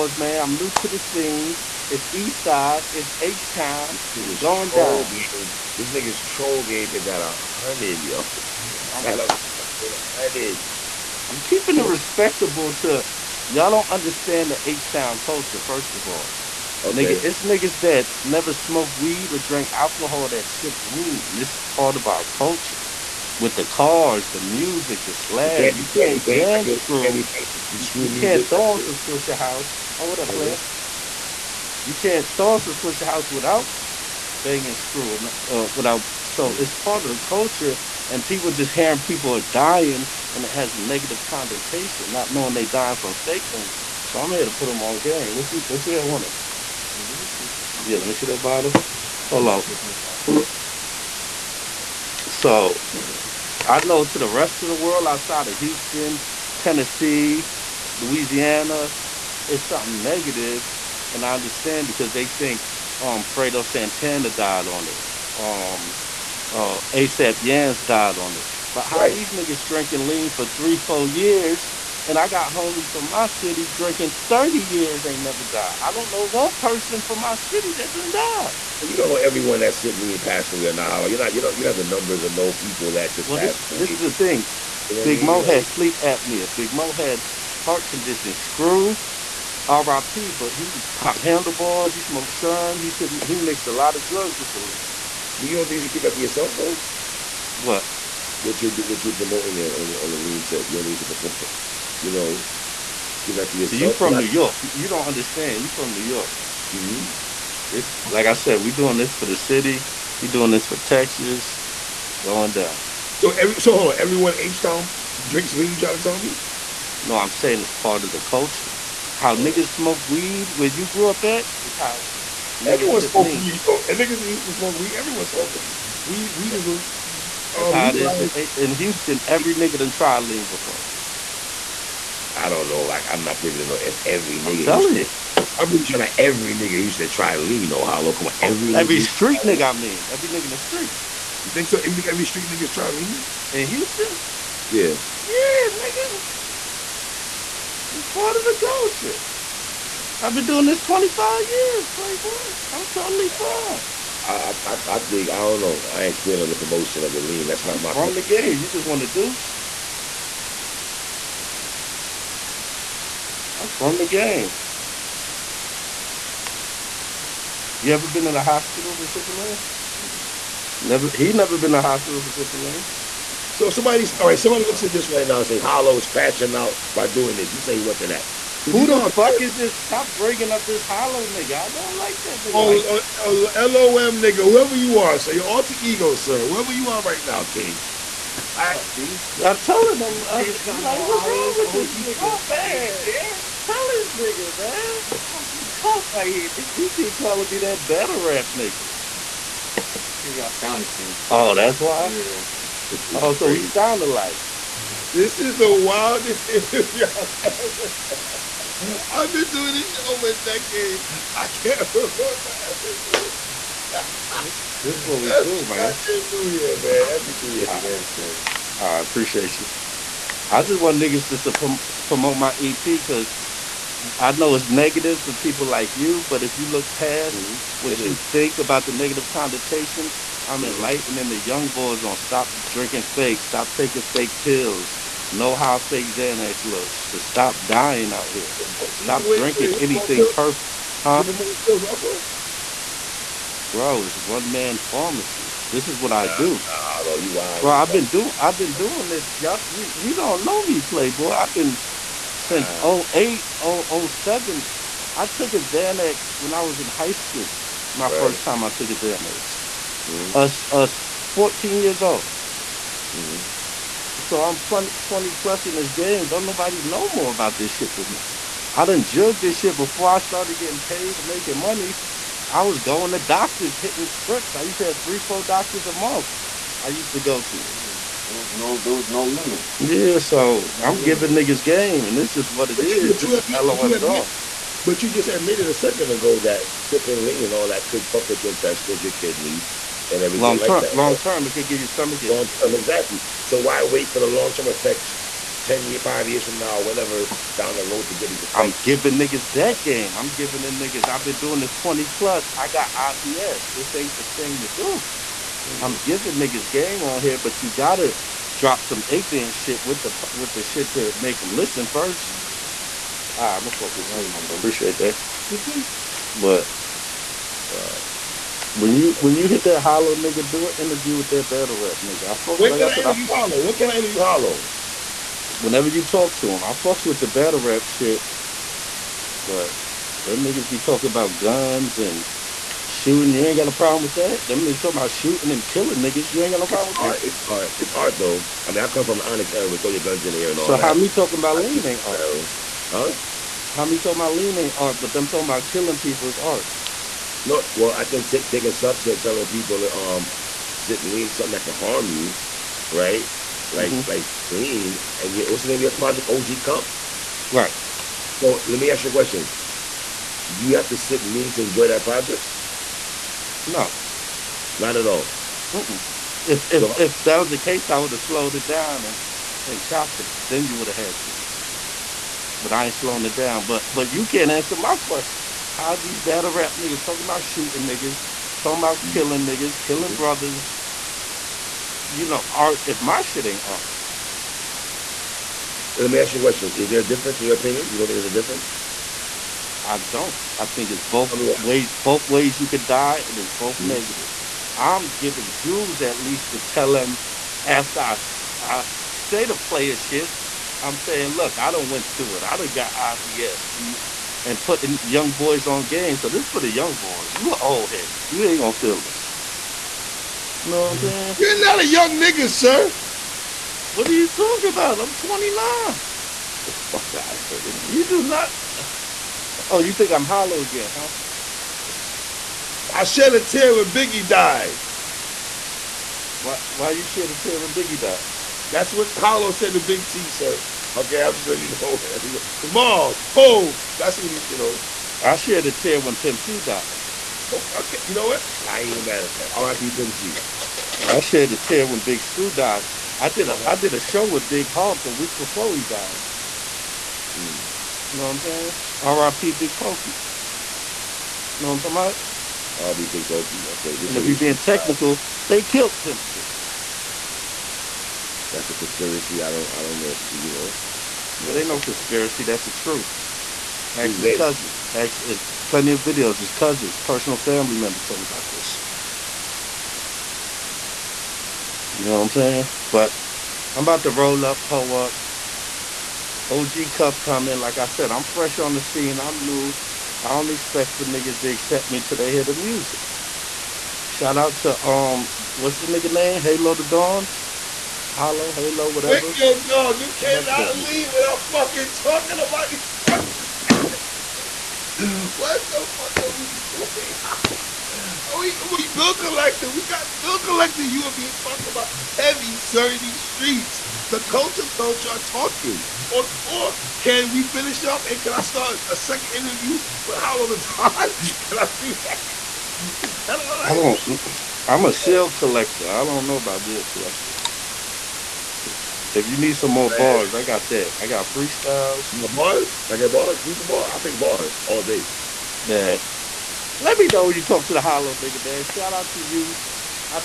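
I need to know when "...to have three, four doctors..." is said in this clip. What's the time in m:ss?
4:34.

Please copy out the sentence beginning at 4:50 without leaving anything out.
Long term, long term, it could give you stomach issues.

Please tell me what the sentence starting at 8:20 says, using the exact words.
You are being talked about heavy, sir, streets.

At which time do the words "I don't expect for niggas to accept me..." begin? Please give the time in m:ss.
8:00.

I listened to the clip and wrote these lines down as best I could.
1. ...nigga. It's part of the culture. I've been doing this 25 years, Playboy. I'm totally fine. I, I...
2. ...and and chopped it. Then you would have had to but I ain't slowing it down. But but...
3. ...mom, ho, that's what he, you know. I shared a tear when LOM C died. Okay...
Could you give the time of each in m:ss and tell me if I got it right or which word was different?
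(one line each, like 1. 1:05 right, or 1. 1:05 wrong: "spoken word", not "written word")
1. 2:25 right
2. 6:09 right
3. 7:12 wrong: "Pimp", not "LOM".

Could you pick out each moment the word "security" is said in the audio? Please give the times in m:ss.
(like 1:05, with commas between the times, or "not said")
not said.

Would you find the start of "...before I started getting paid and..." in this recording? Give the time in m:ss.
4:29.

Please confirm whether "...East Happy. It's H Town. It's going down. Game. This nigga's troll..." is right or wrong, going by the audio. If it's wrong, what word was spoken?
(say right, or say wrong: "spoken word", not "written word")
wrong: "Side", not "Happy".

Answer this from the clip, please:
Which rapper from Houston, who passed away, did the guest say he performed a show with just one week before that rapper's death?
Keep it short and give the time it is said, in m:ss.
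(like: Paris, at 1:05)
Big Hawk, at 7:24.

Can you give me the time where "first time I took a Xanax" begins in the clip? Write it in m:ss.
4:18.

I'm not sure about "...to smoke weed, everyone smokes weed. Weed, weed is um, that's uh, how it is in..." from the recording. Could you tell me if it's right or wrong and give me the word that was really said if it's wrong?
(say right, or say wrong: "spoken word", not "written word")
right.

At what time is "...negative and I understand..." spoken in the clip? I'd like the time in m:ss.
1:00.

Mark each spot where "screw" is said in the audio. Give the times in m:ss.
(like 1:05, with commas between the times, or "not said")
0:26, 0:34, 1:28, 7:22.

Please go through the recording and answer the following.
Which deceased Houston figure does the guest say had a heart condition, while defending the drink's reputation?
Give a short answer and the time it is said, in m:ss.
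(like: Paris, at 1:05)
Big Moe, at 1:26.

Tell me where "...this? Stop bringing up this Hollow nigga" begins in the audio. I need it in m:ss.
2:59.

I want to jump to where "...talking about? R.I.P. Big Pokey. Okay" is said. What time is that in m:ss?
7:31.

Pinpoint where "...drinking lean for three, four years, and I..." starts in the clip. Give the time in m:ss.
1:09.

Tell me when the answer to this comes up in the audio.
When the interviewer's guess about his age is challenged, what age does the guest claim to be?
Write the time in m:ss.
6:55.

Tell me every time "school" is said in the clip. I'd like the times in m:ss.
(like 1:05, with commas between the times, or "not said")
4:17.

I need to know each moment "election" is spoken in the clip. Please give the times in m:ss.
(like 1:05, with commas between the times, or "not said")
not said.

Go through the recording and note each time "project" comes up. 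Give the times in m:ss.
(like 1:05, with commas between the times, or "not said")
5:55, 6:02.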